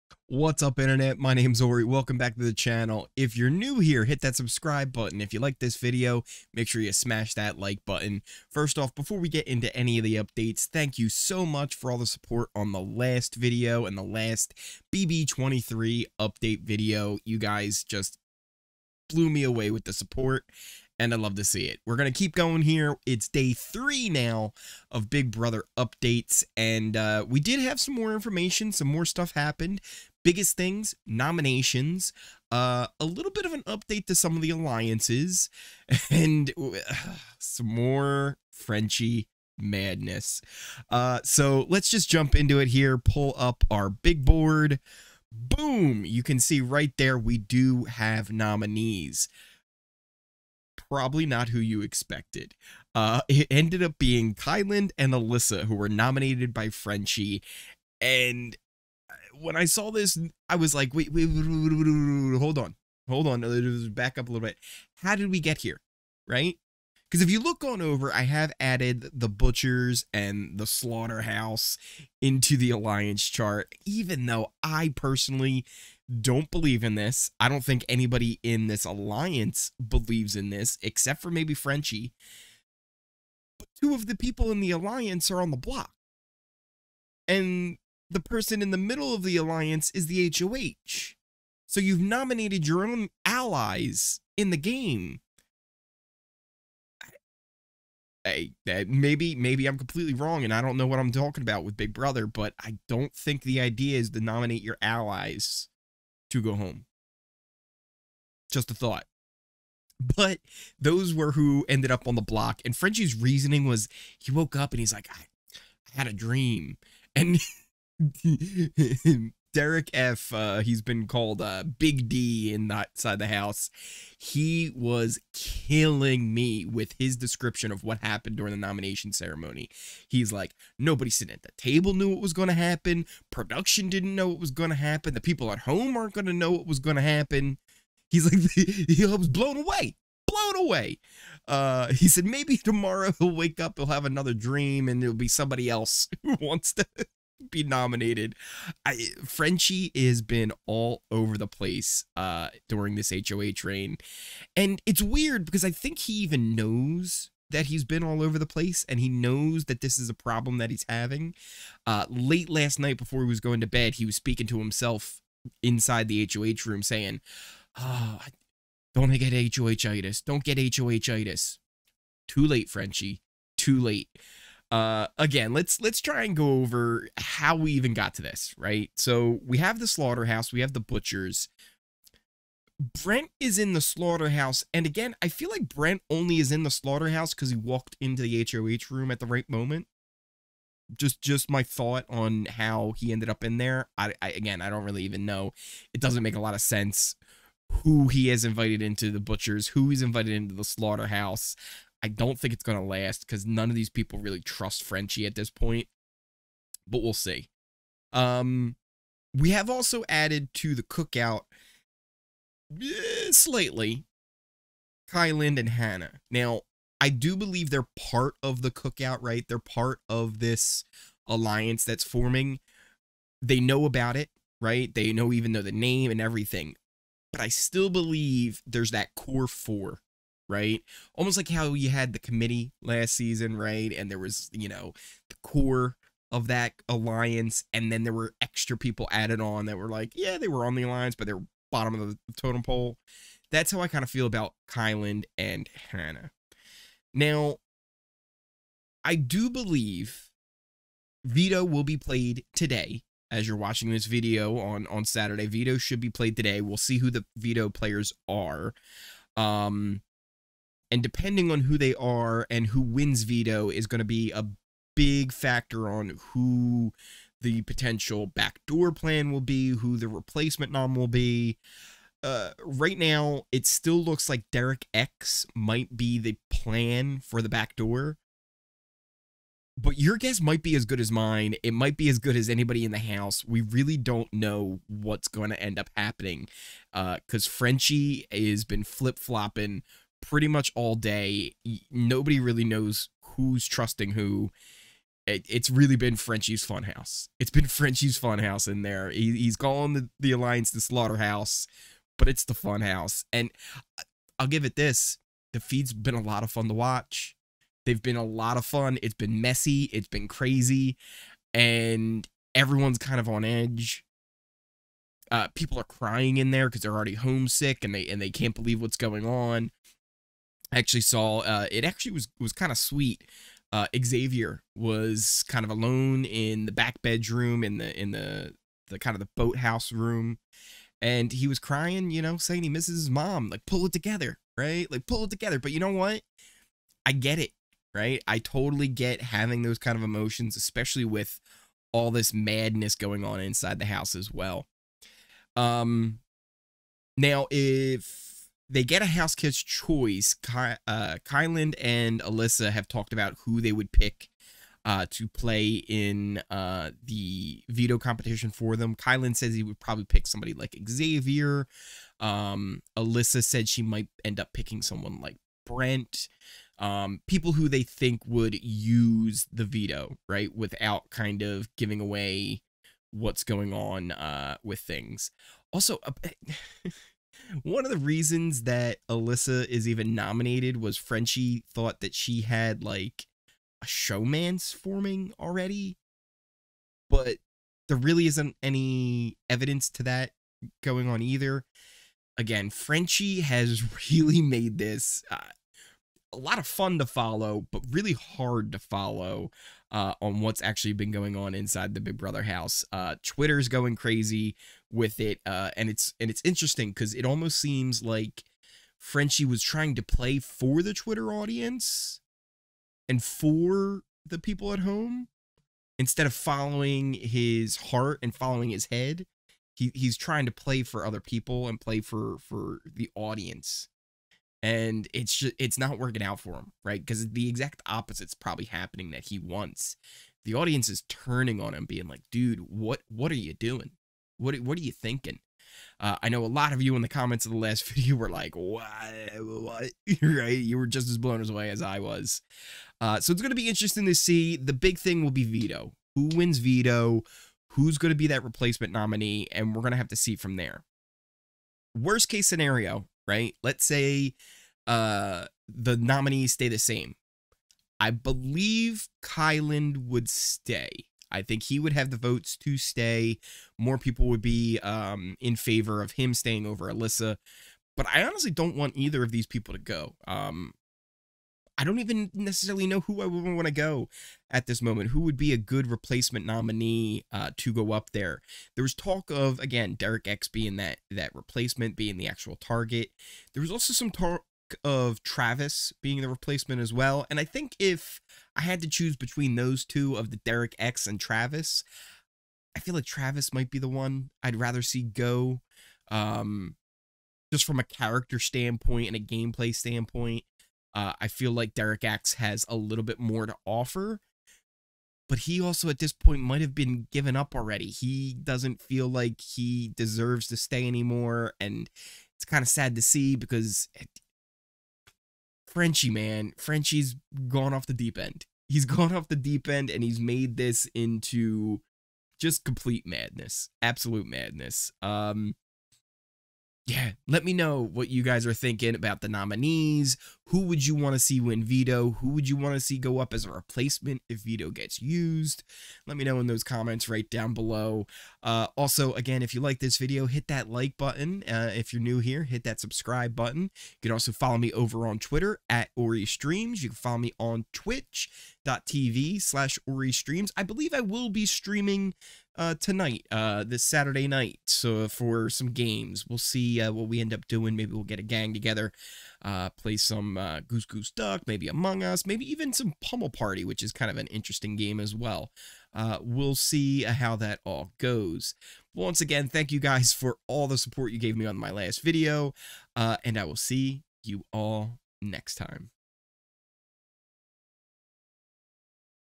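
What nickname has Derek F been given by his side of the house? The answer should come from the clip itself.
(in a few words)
Big D.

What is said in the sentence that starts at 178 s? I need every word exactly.
So we have the slaughterhouse, we have the butchers.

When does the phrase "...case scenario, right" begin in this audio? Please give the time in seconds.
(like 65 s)
452 s.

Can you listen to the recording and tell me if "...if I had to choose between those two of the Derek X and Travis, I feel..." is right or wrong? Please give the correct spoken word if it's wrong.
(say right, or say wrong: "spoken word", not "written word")
right.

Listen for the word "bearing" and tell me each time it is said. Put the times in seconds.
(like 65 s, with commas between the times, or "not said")
not said.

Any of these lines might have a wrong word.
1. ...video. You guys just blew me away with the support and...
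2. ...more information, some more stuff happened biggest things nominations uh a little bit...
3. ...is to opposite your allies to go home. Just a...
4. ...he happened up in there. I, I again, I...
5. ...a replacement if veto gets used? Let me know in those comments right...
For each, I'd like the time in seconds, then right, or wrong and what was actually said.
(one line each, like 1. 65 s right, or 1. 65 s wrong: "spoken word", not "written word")
1. 16 s right
2. 27 s right
3. 103 s wrong: "nominate", not "opposite"
4. 192 s wrong: "ended", not "happened"
5. 533 s right.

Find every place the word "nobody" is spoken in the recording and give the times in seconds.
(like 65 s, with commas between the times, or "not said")
130 s, 291 s.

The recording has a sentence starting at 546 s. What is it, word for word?
You can follow me on twitch.tv slash Ory Streams.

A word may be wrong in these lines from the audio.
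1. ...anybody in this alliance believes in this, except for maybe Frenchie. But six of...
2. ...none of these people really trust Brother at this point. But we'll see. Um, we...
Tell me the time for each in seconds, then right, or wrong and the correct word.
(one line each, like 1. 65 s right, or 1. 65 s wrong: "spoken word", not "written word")
1. 77 s wrong: "two", not "six"
2. 203 s wrong: "Frenchie", not "Brother".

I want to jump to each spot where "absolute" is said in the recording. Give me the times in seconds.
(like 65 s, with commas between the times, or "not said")
523 s.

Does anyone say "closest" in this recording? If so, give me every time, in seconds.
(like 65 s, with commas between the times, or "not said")
not said.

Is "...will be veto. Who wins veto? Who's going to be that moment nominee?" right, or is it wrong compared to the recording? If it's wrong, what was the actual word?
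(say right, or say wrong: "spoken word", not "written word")
wrong: "replacement", not "moment".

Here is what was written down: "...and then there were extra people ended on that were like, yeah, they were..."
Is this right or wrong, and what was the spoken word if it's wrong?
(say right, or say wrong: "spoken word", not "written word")
wrong: "added", not "ended".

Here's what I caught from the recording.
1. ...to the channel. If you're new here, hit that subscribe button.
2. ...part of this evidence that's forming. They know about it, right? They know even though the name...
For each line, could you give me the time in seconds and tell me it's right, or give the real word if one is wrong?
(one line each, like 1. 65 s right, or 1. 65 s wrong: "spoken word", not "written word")
1. 2 s right
2. 219 s wrong: "alliance", not "evidence".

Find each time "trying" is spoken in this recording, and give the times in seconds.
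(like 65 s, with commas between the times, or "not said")
409 s, 420 s.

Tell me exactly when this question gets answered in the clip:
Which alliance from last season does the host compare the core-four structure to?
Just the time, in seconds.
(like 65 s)
232 s.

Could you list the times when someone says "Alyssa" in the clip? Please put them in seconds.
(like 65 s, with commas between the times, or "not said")
55 s, 352 s, 362 s, 379 s, 466 s.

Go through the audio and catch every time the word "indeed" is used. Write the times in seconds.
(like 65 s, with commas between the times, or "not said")
not said.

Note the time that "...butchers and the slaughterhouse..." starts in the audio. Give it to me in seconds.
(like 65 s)
69 s.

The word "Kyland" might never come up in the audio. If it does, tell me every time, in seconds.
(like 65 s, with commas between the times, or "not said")
54 s, 215 s, 244 s, 351 s, 358 s, 459 s.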